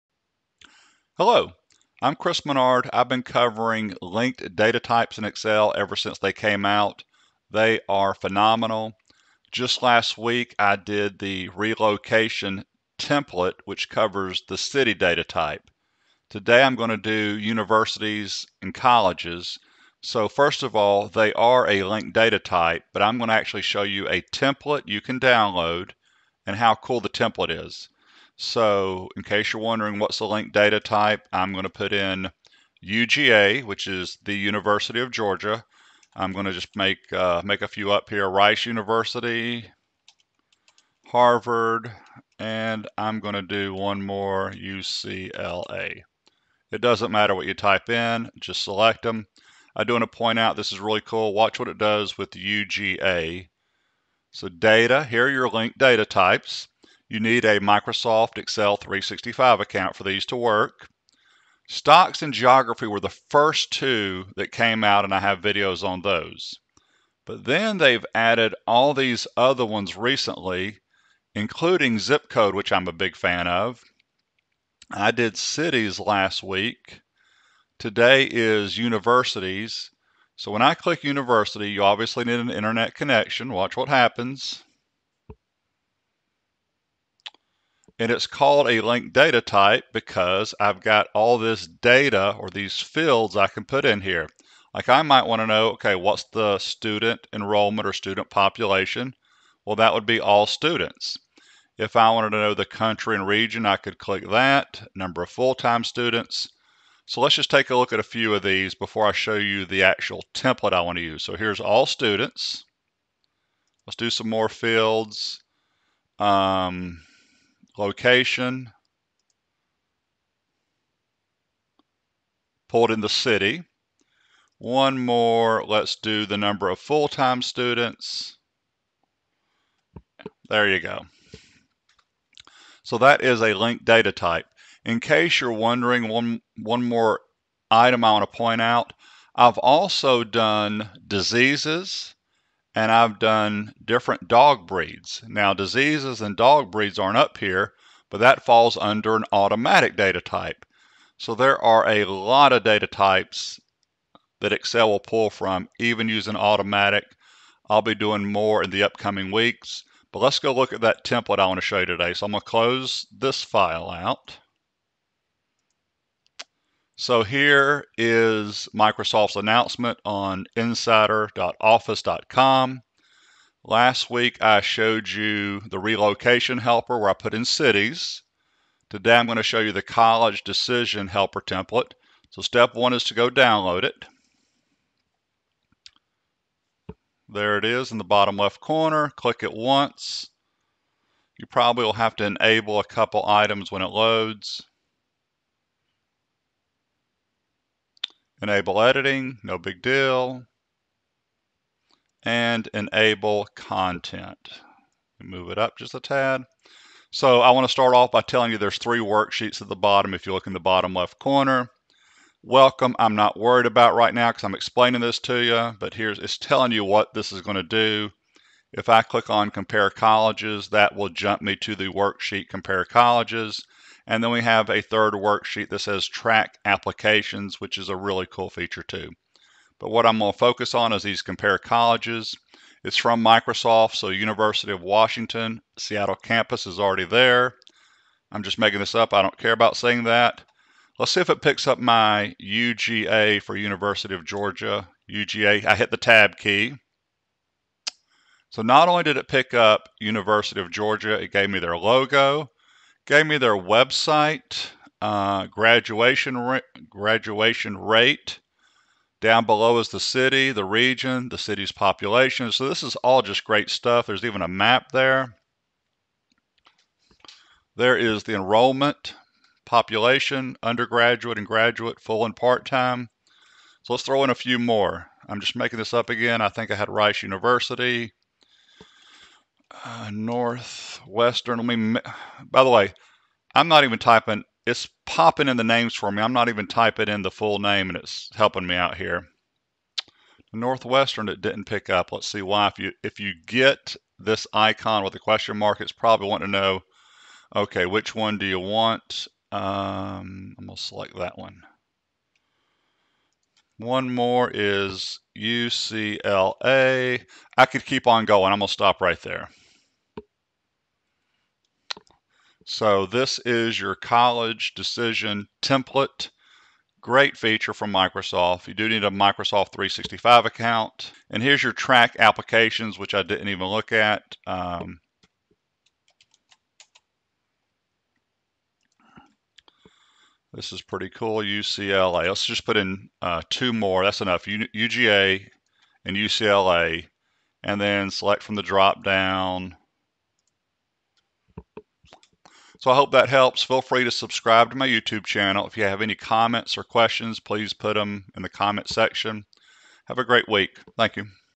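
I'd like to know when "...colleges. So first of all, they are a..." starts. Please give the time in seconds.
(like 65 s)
18 s.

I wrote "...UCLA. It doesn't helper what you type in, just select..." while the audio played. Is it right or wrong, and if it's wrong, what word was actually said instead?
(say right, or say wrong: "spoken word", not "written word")
wrong: "matter", not "helper".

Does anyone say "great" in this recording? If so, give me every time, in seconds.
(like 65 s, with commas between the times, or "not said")
263 s, 317 s, 350 s.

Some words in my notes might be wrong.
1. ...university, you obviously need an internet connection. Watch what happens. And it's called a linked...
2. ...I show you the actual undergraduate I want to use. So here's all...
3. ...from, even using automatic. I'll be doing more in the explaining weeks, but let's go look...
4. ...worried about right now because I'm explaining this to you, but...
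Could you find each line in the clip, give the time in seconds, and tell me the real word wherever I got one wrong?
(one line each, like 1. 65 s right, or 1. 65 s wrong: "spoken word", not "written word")
1. 81 s right
2. 109 s wrong: "template", not "undergraduate"
3. 155 s wrong: "upcoming", not "explaining"
4. 213 s right.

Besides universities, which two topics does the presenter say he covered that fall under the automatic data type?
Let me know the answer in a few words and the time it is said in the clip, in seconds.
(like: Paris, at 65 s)
Diseases and dog breeds, at 141 s.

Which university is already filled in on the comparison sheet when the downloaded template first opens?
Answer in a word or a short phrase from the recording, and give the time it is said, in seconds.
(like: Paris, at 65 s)
University of Washington, Seattle, at 234 s.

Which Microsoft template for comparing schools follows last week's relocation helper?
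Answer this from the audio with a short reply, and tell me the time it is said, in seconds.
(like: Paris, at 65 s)
College decision helper, at 179 s.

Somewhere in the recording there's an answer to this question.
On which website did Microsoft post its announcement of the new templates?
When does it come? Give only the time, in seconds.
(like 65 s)
170 s.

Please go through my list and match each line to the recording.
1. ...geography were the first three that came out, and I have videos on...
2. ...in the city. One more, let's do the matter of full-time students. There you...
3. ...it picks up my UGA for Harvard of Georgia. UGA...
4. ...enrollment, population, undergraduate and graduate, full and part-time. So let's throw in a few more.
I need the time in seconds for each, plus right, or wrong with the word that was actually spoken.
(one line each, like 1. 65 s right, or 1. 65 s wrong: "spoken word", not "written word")
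1. 62 s wrong: "two", not "three"
2. 122 s wrong: "number", not "matter"
3. 241 s wrong: "University", not "Harvard"
4. 268 s right.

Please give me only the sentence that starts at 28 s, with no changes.
So in case you're wondering what's the link data type, I'm going to put in UGA, which is the University of Georgia.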